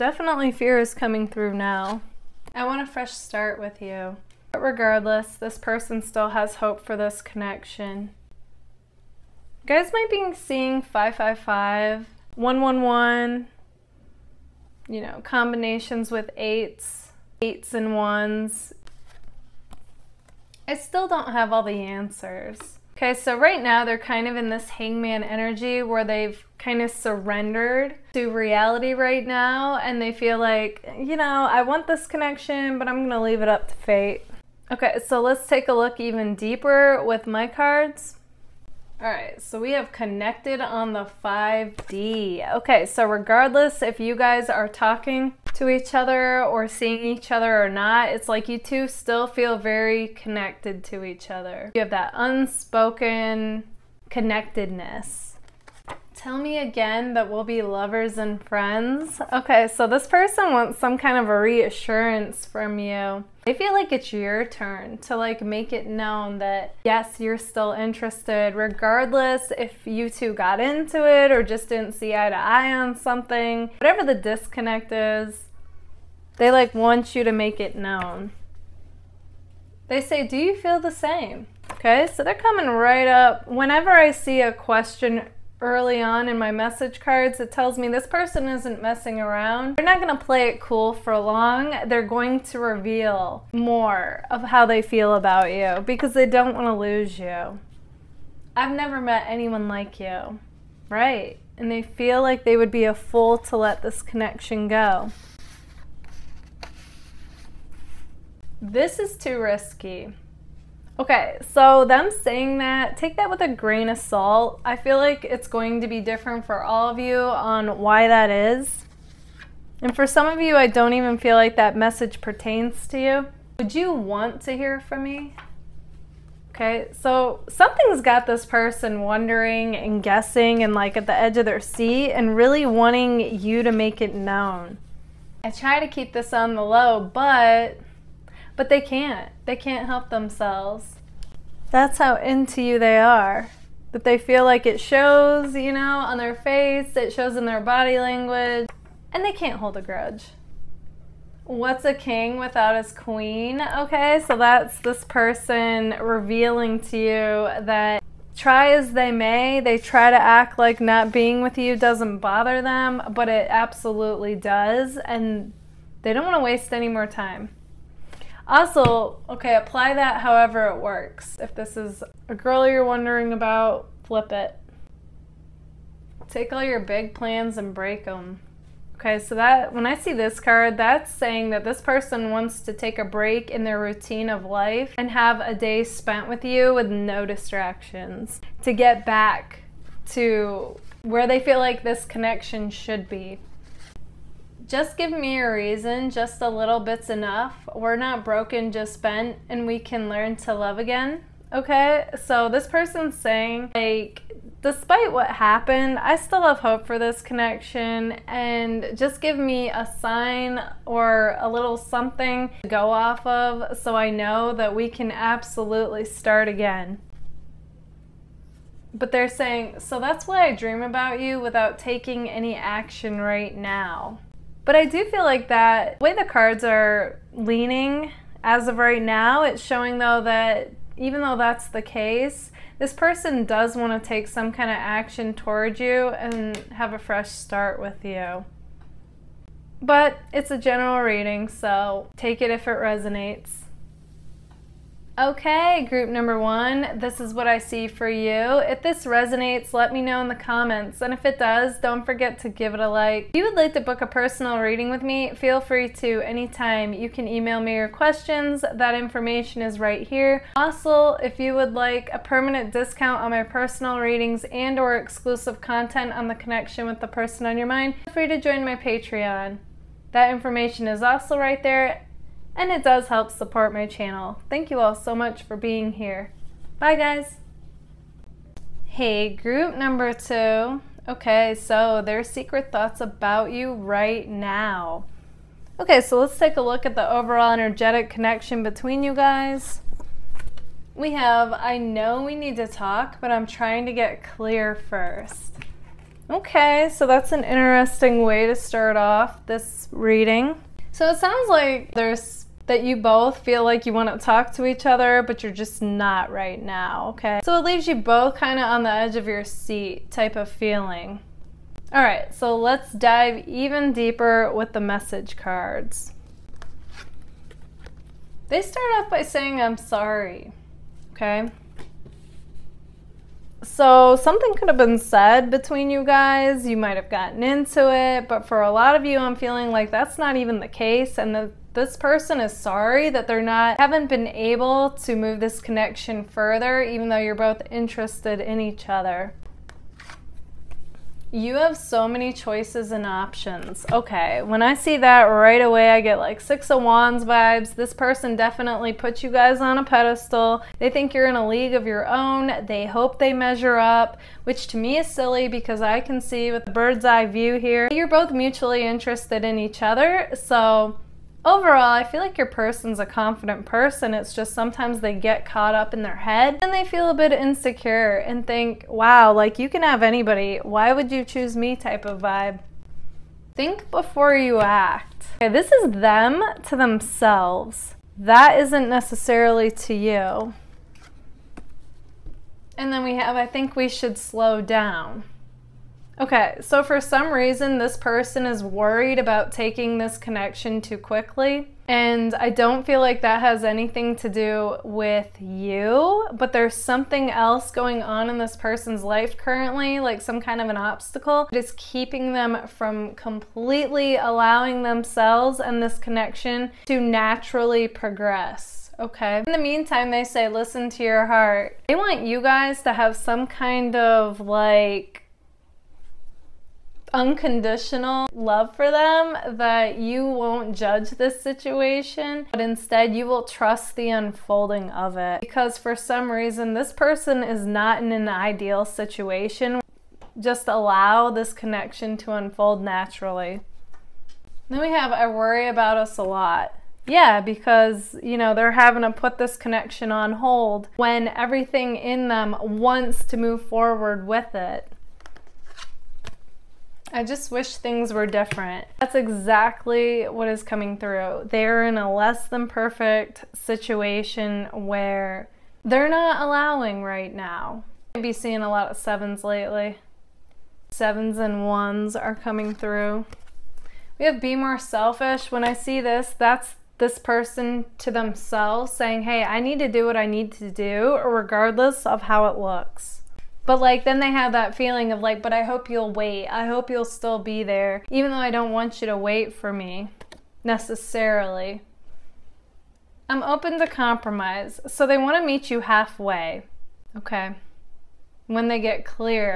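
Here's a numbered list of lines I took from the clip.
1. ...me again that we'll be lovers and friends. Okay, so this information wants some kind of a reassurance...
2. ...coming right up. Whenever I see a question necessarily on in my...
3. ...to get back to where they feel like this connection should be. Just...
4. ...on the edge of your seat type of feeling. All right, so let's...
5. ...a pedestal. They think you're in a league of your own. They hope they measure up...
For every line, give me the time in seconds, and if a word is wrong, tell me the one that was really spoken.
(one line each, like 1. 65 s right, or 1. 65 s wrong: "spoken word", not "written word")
1. 56 s wrong: "person", not "information"
2. 82 s wrong: "early", not "necessarily"
3. 188 s right
4. 308 s right
5. 349 s right.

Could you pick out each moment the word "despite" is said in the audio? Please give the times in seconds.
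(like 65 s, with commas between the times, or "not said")
204 s.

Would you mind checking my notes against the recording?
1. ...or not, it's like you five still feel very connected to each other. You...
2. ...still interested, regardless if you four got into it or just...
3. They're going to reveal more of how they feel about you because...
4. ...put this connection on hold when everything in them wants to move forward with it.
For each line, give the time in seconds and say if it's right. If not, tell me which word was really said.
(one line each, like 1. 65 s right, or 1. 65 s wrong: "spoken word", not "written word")
1. 47 s wrong: "two", not "five"
2. 67 s wrong: "two", not "four"
3. 91 s right
4. 439 s right.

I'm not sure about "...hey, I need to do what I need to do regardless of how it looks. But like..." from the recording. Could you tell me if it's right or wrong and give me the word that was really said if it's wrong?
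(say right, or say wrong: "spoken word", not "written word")
right.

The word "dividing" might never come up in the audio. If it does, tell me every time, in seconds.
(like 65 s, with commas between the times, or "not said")
not said.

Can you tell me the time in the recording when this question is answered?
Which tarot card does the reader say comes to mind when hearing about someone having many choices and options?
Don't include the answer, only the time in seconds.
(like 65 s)
346 s.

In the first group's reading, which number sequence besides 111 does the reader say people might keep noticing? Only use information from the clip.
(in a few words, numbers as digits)
555.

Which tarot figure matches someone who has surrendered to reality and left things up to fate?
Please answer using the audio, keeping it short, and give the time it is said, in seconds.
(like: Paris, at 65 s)
Hangman, at 24 s.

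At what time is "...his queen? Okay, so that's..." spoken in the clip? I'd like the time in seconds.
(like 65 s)
152 s.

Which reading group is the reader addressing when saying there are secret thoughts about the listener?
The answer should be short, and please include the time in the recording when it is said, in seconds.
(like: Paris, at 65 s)
Group number two, at 279 s.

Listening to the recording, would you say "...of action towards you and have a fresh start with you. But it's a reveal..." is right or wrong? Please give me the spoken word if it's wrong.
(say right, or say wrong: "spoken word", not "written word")
wrong: "general", not "reveal".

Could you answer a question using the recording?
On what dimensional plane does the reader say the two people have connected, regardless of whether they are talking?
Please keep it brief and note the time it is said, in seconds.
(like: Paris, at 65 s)
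5D, at 41 s.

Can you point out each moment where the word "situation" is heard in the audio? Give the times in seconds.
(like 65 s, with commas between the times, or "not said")
421 s, 428 s, 453 s.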